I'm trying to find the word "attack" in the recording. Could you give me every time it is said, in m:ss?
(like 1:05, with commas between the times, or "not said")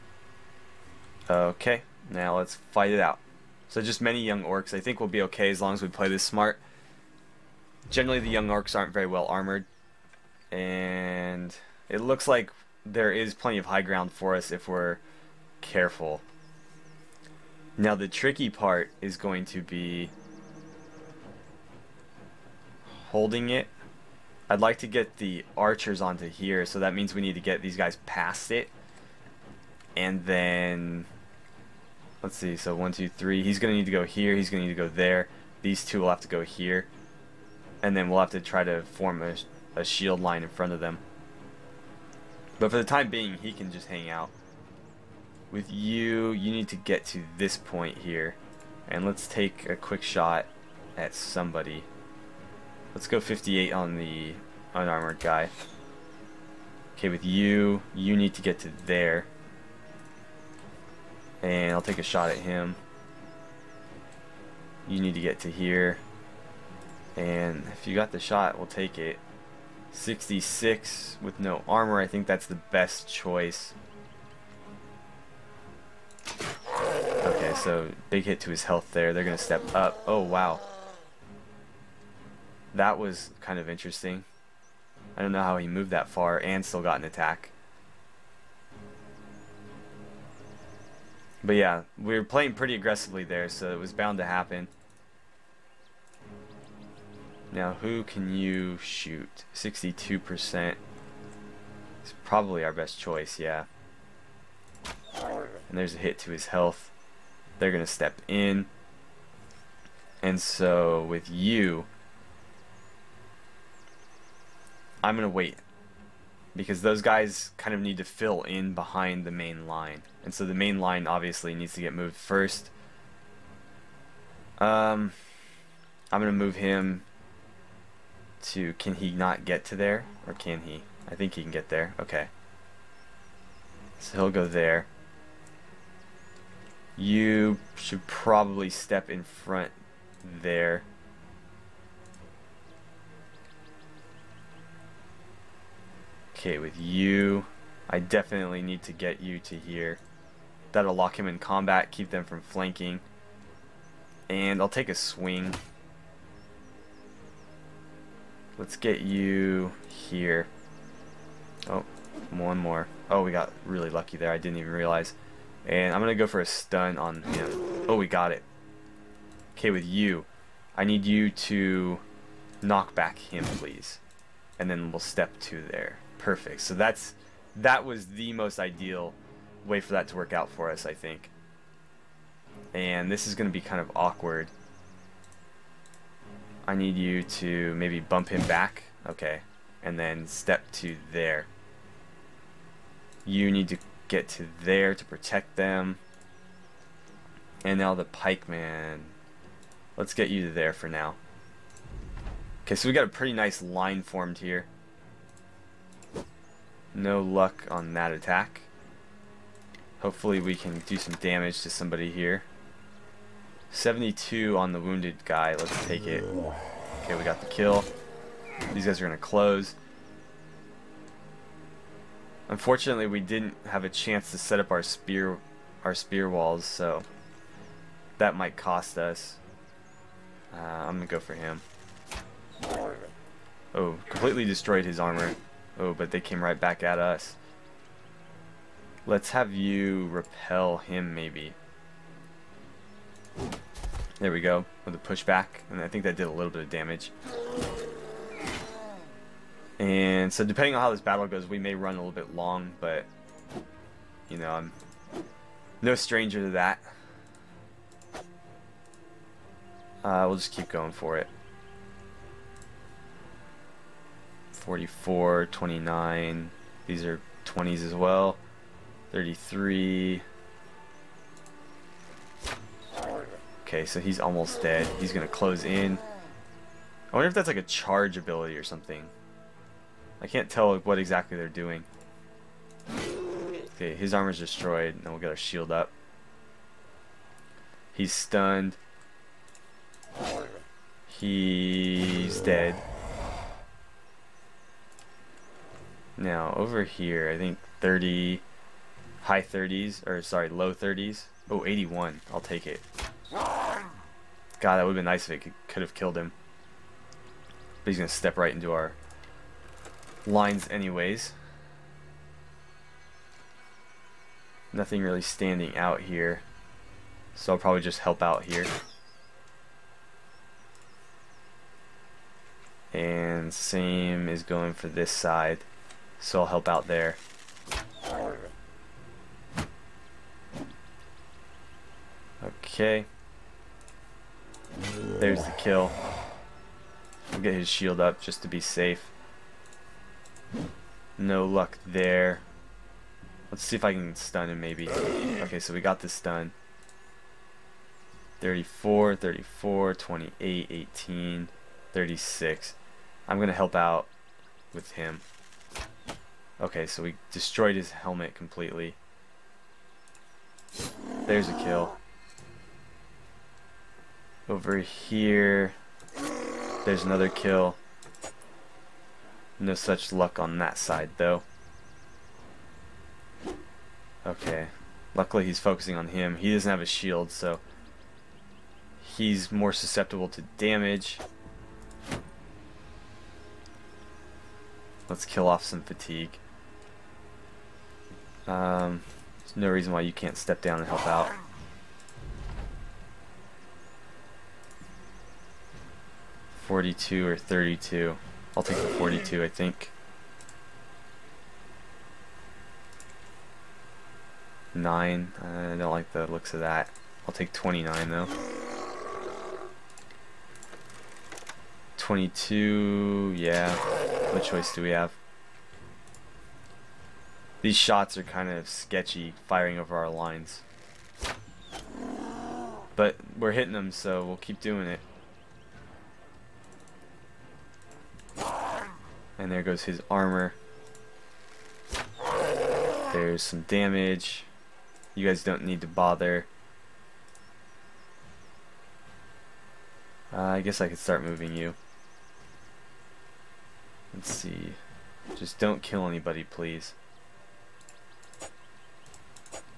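1:27, 3:28.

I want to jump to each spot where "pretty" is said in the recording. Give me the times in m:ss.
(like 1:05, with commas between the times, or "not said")
1:32, 3:23.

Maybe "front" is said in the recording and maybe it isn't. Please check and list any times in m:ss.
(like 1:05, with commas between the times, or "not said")
0:40, 2:19.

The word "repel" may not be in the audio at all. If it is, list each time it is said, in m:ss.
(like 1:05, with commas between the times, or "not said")
4:00.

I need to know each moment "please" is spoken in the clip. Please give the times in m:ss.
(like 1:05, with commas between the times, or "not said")
2:53, 7:26.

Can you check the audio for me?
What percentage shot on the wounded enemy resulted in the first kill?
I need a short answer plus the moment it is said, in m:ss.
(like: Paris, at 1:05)
72, at 3:33.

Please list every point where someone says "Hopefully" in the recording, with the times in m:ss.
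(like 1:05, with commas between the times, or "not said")
3:30.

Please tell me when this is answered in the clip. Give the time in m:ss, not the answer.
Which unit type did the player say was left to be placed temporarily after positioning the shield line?
3:18.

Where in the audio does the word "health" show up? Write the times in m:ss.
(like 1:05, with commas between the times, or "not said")
1:18, 1:46.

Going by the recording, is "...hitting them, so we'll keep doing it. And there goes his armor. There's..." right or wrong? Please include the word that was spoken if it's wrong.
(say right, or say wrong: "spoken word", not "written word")
right.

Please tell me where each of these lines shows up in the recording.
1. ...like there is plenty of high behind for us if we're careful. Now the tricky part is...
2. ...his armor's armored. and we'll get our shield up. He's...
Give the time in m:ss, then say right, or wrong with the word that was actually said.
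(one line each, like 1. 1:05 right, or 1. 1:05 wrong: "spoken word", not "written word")
1. 0:12 wrong: "ground", not "behind"
2. 4:43 wrong: "destroyed", not "armored".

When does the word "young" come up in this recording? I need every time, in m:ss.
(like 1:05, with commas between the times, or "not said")
0:04, 0:08.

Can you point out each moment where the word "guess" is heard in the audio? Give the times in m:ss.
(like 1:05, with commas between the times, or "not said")
7:20.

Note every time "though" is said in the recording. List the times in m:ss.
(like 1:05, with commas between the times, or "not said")
6:11, 6:48.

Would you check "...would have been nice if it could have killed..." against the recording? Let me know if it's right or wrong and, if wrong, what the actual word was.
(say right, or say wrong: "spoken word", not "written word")
right.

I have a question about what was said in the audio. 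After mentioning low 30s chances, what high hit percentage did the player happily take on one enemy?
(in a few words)
81.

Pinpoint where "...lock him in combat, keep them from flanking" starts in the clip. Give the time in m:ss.
2:30.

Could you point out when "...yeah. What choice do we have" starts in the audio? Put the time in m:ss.
6:53.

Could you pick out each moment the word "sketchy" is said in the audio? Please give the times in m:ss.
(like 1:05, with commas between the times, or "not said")
6:58.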